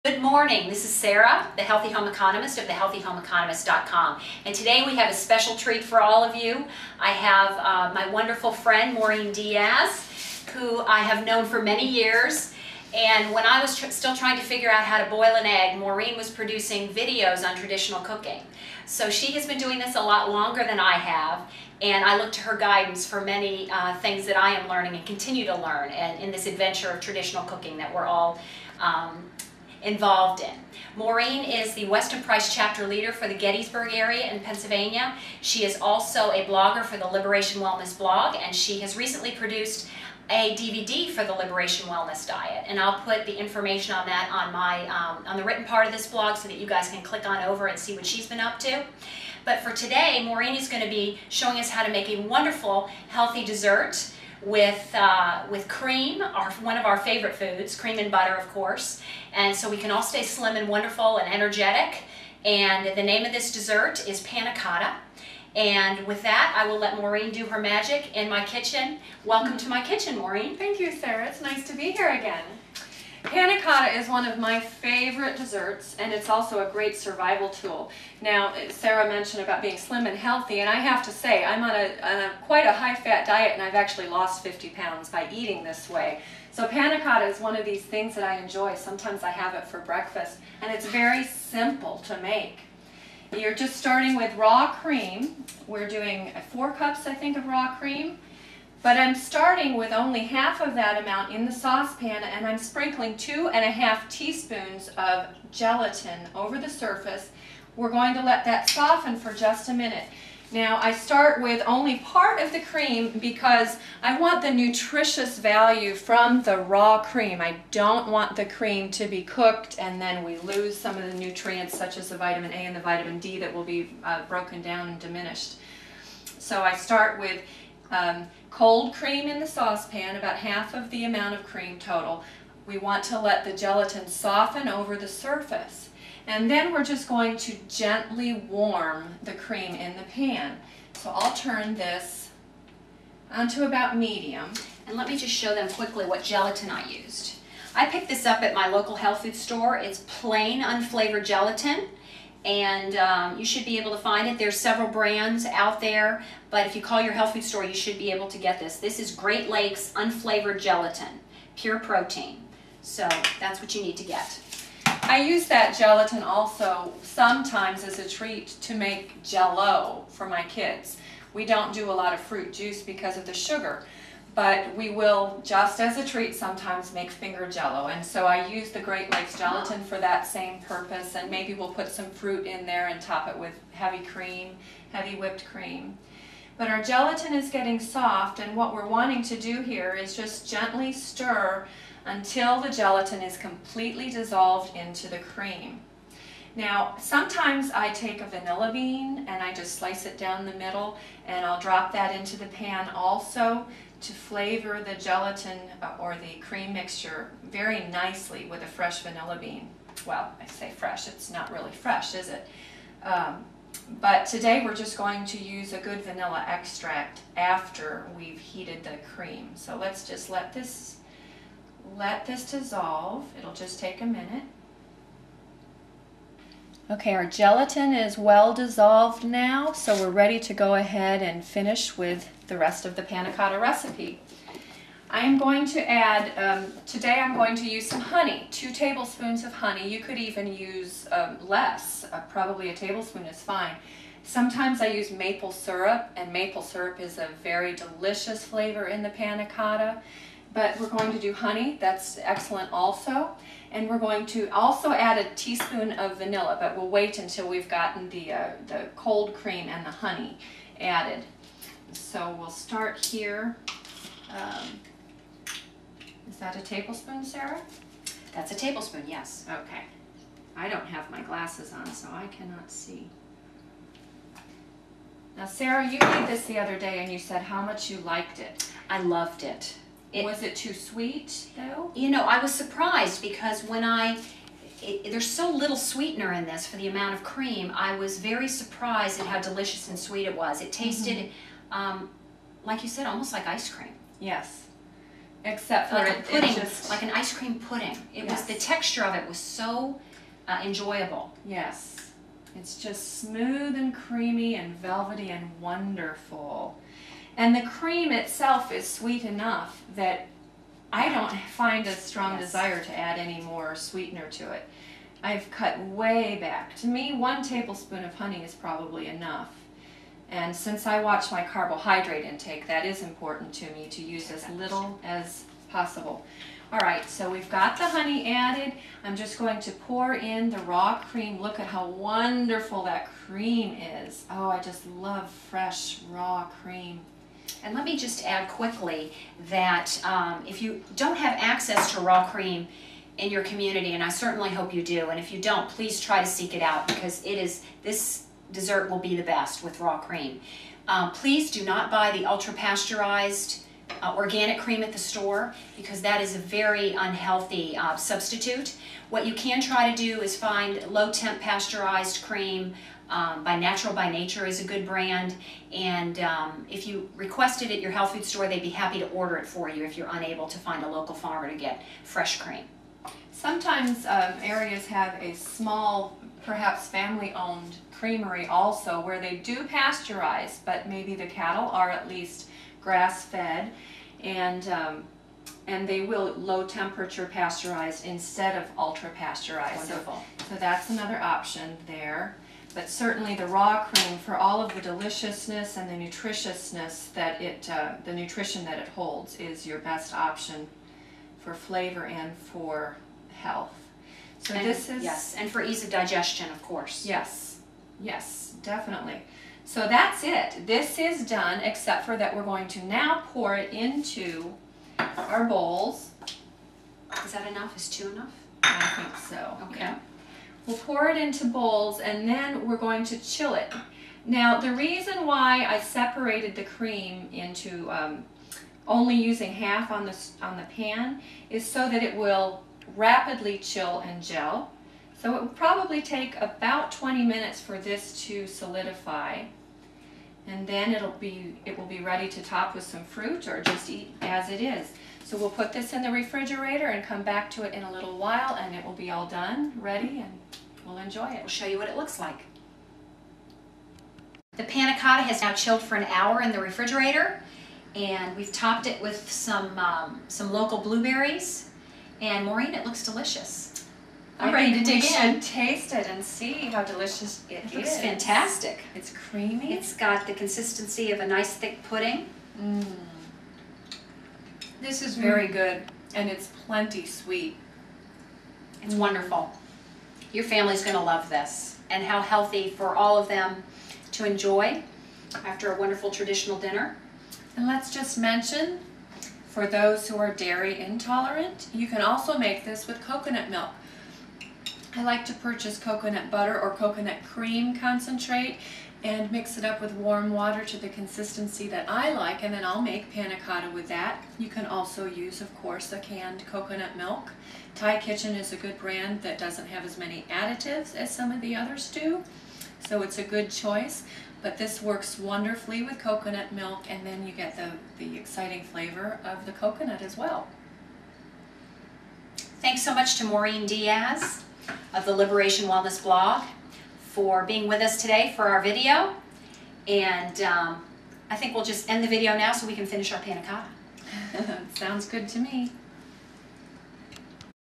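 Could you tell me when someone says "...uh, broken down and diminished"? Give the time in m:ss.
2:04.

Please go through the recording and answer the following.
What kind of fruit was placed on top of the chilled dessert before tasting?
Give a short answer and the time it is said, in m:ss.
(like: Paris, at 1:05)
blueberries, at 7:40.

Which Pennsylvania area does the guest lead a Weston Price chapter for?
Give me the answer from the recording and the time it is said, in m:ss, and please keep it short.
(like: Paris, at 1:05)
Gettysburg, at 0:33.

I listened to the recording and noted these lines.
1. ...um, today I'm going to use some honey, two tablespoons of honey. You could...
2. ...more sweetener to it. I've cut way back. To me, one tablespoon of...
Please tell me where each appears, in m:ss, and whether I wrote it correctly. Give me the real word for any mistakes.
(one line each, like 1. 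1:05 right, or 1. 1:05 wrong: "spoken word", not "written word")
1. 3:56 right
2. 5:13 right.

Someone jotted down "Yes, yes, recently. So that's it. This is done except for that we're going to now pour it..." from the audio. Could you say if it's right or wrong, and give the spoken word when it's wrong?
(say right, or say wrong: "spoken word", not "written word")
wrong: "definitely", not "recently".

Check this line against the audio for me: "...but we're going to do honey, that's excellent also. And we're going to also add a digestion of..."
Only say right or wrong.
wrong.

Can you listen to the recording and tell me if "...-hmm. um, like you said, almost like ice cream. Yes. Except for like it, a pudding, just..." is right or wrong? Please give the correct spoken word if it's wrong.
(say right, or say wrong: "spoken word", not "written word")
right.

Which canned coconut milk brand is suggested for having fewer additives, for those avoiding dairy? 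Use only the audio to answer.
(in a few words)
Thai Kitchen.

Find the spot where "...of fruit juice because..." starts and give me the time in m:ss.
2:52.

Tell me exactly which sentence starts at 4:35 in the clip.
Now, Sarah, you made this the other day, and you said how much you liked it.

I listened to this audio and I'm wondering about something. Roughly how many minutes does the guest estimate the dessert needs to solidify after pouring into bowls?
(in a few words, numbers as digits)
20.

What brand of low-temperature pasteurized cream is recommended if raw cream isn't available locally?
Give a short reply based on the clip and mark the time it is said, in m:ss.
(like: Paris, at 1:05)
Natural by Nature, at 6:03.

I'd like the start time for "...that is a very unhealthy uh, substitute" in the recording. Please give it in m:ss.
5:56.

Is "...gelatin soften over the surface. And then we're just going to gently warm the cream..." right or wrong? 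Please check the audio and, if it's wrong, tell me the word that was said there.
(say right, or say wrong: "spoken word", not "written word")
right.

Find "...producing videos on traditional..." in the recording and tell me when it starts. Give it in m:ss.
0:16.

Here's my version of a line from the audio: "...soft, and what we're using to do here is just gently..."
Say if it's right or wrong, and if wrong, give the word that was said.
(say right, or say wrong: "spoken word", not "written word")
wrong: "wanting", not "using".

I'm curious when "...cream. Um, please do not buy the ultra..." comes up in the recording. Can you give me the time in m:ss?
5:49.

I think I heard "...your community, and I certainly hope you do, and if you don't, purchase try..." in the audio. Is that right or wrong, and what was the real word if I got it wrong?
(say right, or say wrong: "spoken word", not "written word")
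wrong: "please", not "purchase".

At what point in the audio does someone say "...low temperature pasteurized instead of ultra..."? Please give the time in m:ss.
6:26.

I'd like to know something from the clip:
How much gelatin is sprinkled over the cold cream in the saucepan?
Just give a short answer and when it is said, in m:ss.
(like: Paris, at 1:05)
2.5 teaspoons, at 1:43.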